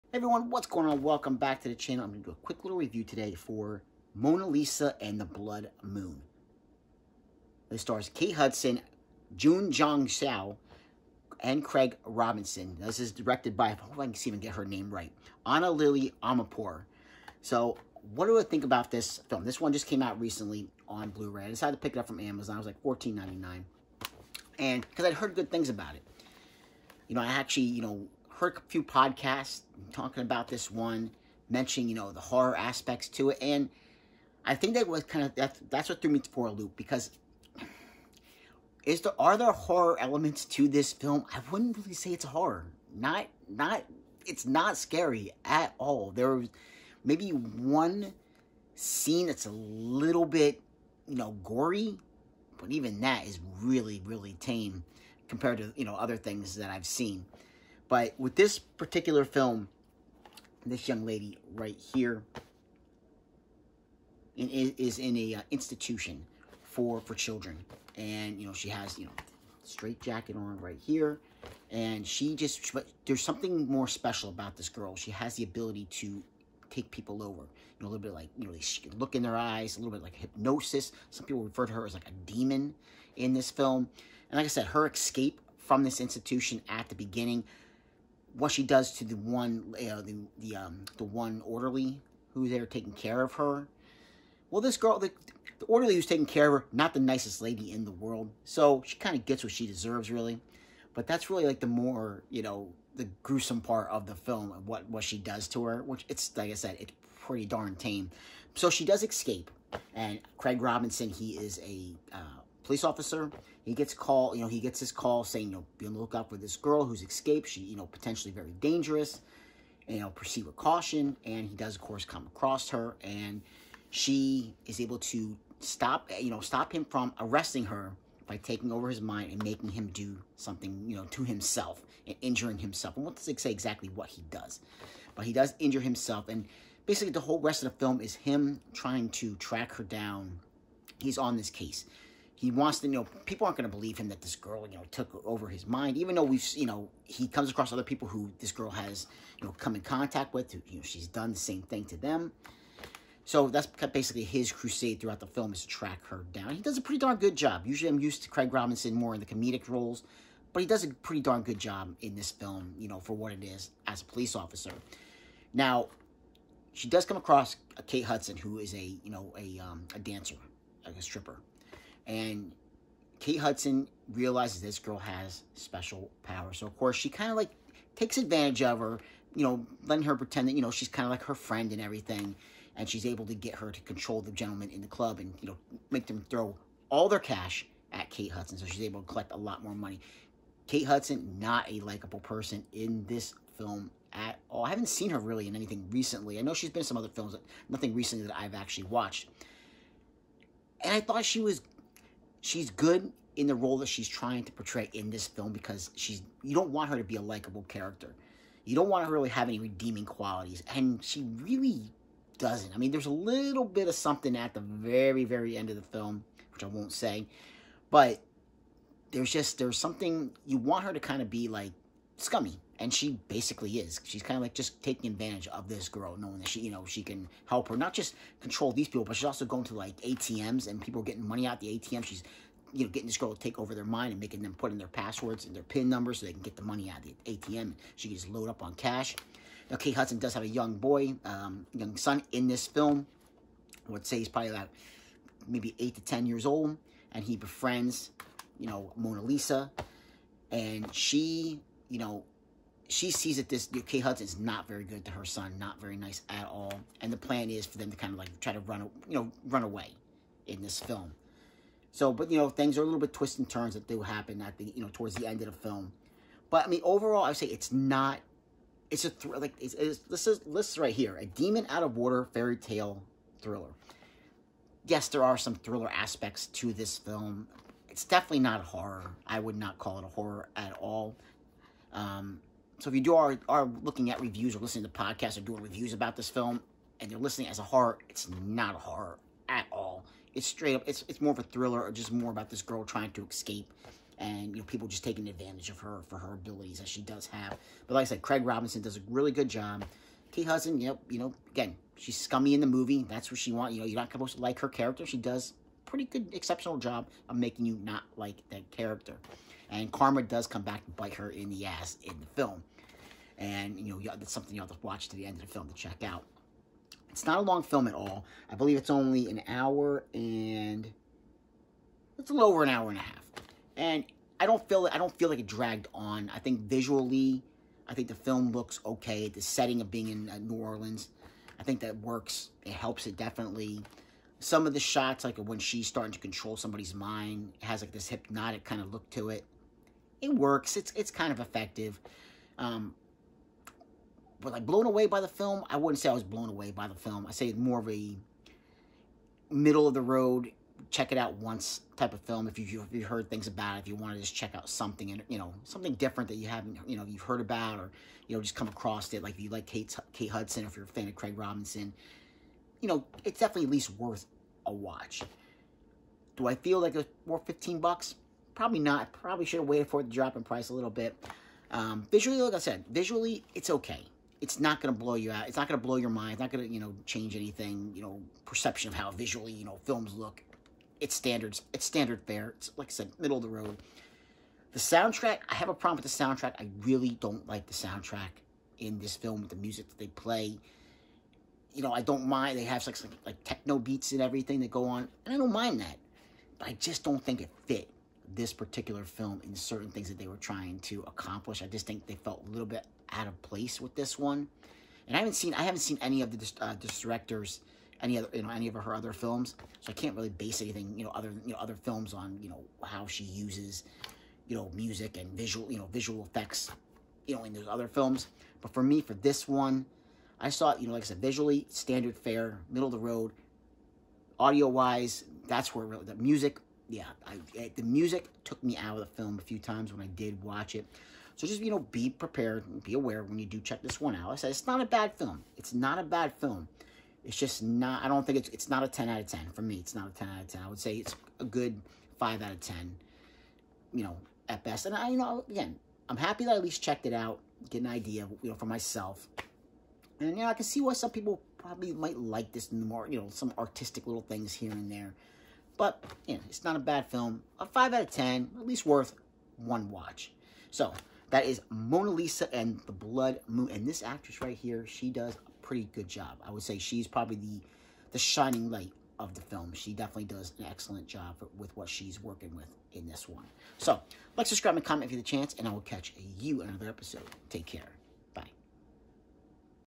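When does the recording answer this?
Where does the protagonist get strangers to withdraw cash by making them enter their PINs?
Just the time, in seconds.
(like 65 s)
230 s.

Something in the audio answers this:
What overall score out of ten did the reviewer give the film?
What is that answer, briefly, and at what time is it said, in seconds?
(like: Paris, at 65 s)
5, at 442 s.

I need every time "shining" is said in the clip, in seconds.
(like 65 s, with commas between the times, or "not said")
468 s.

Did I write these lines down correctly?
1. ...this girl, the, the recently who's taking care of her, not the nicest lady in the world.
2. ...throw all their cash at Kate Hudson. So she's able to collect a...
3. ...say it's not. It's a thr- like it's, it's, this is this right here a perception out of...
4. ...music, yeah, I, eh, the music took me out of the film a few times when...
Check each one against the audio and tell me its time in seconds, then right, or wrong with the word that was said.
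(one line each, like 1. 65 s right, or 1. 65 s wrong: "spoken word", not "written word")
1. 94 s wrong: "orderly", not "recently"
2. 186 s right
3. 267 s wrong: "demon", not "perception"
4. 426 s right.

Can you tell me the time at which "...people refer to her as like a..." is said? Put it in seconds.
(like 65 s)
81 s.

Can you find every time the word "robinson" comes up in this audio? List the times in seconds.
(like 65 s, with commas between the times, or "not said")
12 s, 110 s, 158 s, 298 s, 361 s.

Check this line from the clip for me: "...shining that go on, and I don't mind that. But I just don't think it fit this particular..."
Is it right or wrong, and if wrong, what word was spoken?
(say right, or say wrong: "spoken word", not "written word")
wrong: "everything", not "shining".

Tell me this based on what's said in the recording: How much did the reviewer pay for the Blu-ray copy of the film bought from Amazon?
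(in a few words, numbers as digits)
$14.99.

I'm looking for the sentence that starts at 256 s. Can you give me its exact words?
And the plan is for them to kind of like try to run, you know, run away in this film.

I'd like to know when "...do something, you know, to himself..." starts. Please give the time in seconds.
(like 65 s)
129 s.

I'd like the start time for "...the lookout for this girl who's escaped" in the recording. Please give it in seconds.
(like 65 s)
115 s.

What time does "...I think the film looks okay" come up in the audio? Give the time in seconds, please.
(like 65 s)
327 s.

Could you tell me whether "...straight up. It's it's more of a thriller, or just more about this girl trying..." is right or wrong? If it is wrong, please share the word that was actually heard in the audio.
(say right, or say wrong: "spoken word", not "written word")
right.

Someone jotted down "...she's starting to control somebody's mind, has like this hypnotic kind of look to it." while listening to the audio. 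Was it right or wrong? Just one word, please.
right.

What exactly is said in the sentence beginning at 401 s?
I just think they felt a little bit out of place with this one.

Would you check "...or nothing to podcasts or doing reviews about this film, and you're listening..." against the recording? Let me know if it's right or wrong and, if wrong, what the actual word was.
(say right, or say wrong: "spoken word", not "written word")
wrong: "listening", not "nothing".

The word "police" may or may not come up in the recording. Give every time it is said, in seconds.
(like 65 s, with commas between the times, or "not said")
112 s, 164 s.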